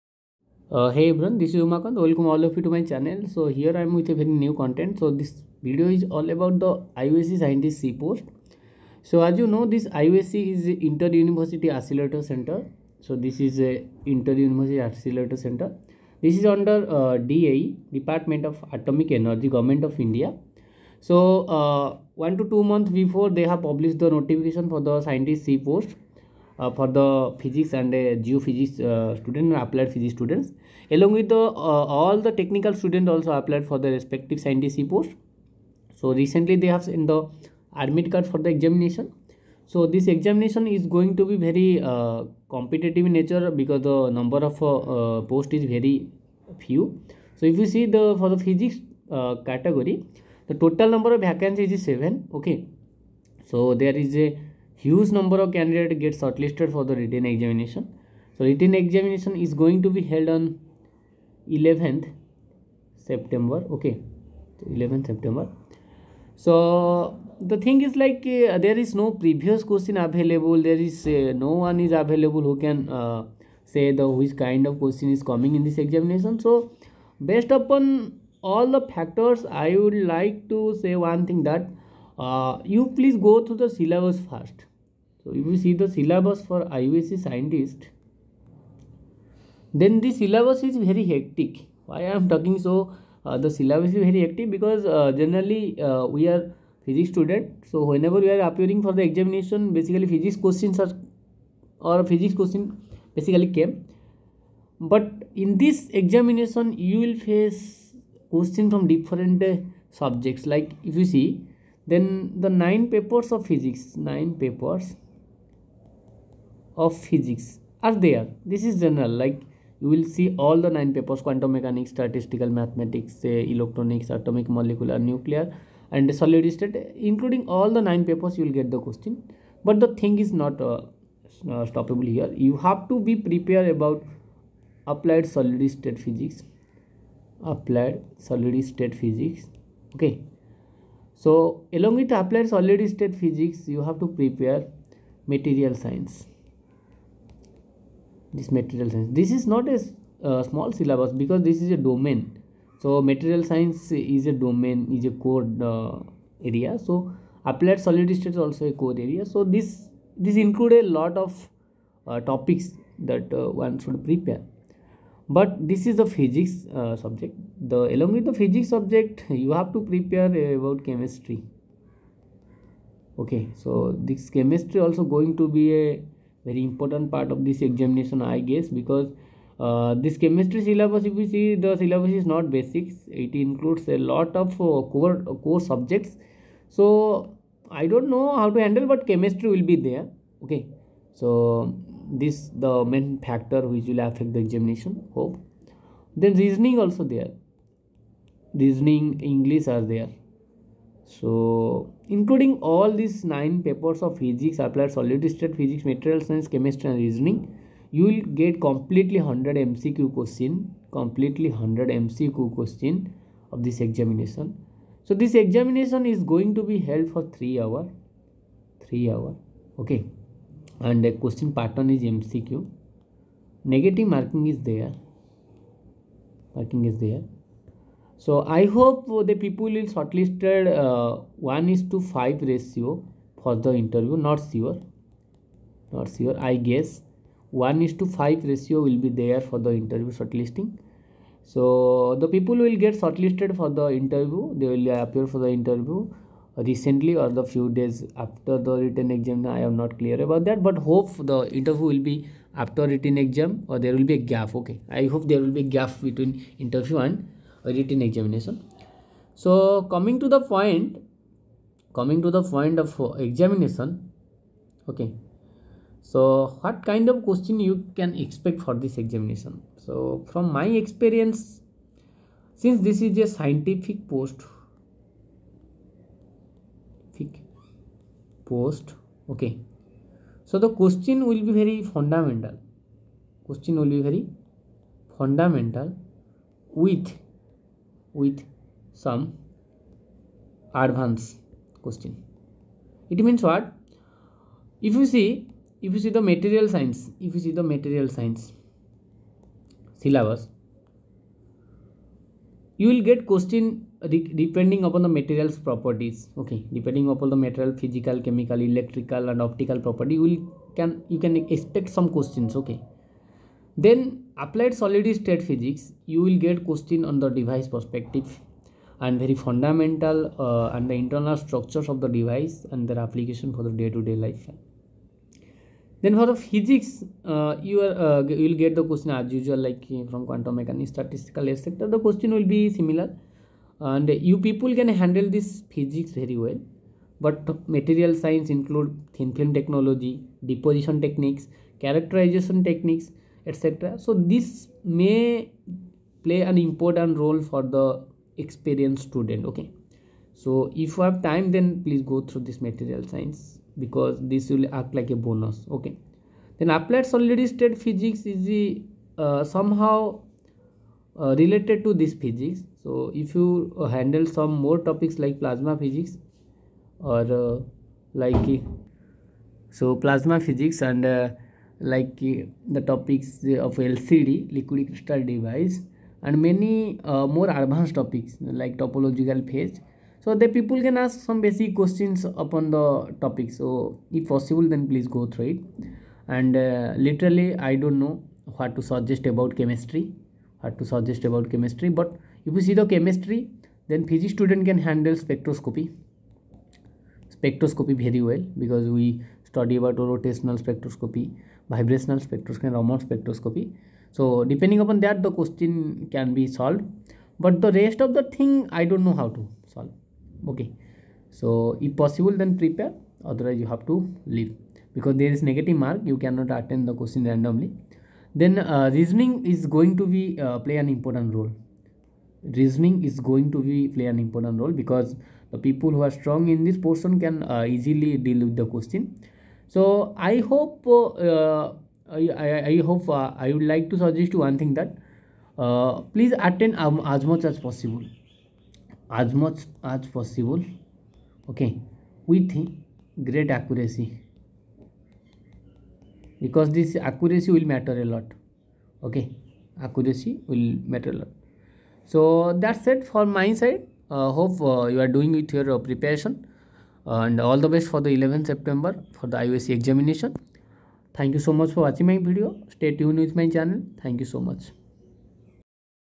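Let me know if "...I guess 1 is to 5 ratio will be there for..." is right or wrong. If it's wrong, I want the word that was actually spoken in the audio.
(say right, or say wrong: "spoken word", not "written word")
right.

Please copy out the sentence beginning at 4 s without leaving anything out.
So this video is all about the IUAC scientist C post.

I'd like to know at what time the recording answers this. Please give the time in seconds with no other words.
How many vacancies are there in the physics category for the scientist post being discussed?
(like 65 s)
51 s.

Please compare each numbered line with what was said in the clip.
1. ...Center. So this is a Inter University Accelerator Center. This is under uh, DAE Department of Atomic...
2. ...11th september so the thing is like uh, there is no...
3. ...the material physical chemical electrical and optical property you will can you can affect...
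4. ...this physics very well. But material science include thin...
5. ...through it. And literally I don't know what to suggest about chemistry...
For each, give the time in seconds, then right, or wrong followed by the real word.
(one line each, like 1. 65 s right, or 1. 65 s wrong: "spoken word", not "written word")
1. 12 s right
2. 64 s right
3. 307 s wrong: "expect", not "affect"
4. 335 s right
5. 385 s right.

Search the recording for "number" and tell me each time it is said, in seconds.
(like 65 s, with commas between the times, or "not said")
44 s, 50 s, 55 s.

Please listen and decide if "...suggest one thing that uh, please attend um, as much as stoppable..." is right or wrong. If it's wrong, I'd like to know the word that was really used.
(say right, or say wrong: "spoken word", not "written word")
wrong: "possible", not "stoppable".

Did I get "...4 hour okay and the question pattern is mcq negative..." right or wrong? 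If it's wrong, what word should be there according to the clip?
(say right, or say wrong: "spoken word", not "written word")
wrong: "3", not "4".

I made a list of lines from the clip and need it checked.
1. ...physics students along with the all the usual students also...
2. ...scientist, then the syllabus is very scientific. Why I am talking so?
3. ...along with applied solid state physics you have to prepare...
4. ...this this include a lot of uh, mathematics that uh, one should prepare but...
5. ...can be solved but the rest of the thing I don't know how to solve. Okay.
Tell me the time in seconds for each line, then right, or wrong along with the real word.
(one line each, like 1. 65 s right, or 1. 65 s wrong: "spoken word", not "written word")
1. 29 s wrong: "technical", not "usual"
2. 87 s wrong: "hectic", not "scientific"
3. 141 s right
4. 159 s wrong: "topics", not "mathematics"
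5. 406 s right.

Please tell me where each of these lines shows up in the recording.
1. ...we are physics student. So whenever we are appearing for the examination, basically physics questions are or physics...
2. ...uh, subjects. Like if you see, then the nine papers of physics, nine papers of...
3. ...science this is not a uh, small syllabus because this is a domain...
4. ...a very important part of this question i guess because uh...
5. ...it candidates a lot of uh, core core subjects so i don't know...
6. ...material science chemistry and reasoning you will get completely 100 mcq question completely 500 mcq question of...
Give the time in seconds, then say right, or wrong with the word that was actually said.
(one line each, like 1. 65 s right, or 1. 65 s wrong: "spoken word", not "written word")
1. 96 s right
2. 109 s right
3. 148 s right
4. 175 s wrong: "examination", not "question"
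5. 183 s wrong: "includes", not "candidates"
6. 205 s wrong: "100", not "500".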